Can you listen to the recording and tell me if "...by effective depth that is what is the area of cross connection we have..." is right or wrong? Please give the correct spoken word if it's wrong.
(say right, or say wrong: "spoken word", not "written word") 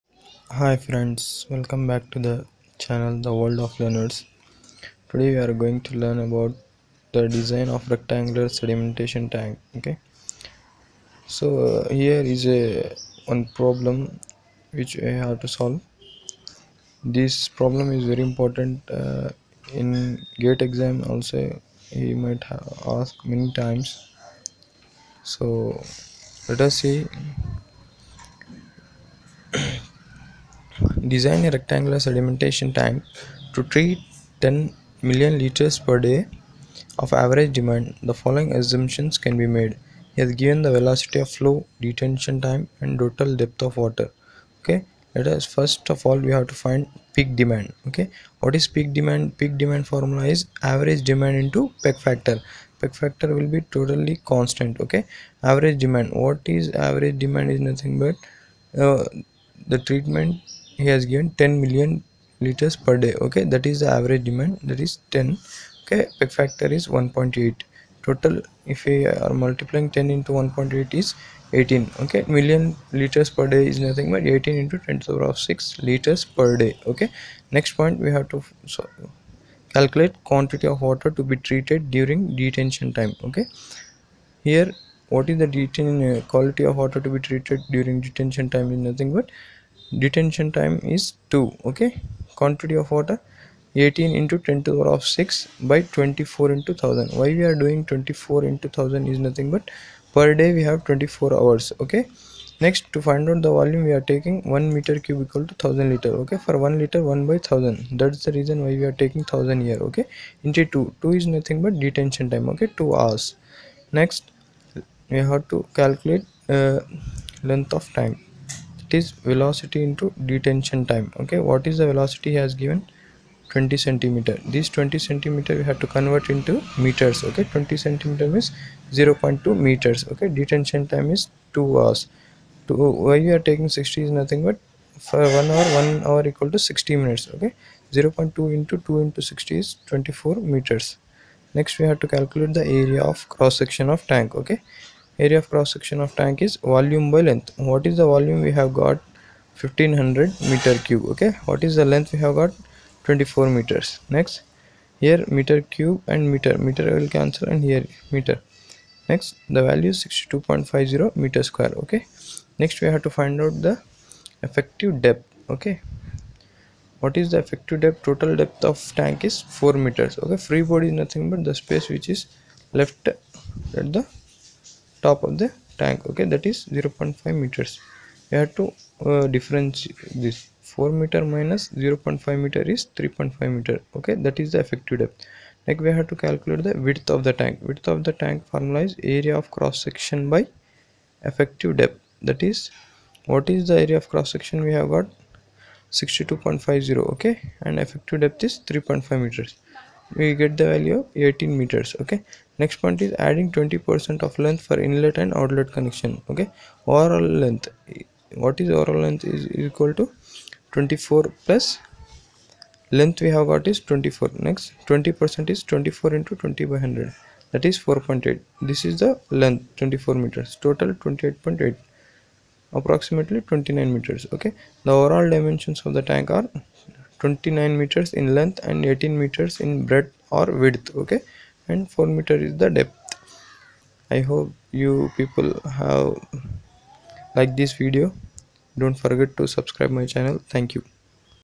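wrong: "section", not "connection".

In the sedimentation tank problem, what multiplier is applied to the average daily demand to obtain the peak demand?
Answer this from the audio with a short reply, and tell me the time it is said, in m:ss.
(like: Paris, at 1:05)
1.8, at 1:06.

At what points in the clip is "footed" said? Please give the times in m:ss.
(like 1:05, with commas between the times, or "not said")
not said.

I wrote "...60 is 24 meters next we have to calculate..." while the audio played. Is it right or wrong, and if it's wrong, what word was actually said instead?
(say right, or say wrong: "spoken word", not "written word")
right.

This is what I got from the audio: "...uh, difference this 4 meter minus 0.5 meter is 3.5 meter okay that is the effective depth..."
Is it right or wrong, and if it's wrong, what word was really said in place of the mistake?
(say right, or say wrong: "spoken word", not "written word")
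right.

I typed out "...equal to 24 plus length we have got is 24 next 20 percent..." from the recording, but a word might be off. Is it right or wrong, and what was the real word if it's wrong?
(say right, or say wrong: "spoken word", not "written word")
right.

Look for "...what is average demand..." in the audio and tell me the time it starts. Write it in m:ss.
0:56.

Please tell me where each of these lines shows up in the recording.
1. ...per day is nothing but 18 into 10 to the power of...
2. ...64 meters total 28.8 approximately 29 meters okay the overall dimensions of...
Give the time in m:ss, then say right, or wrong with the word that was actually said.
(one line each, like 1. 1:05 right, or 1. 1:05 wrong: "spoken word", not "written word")
1. 1:13 right
2. 3:39 wrong: "24", not "64".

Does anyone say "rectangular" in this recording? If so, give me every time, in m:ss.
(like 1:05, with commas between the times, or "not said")
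0:07, 0:31.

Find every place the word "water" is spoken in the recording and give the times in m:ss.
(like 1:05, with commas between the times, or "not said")
0:43, 1:20, 1:26, 1:32.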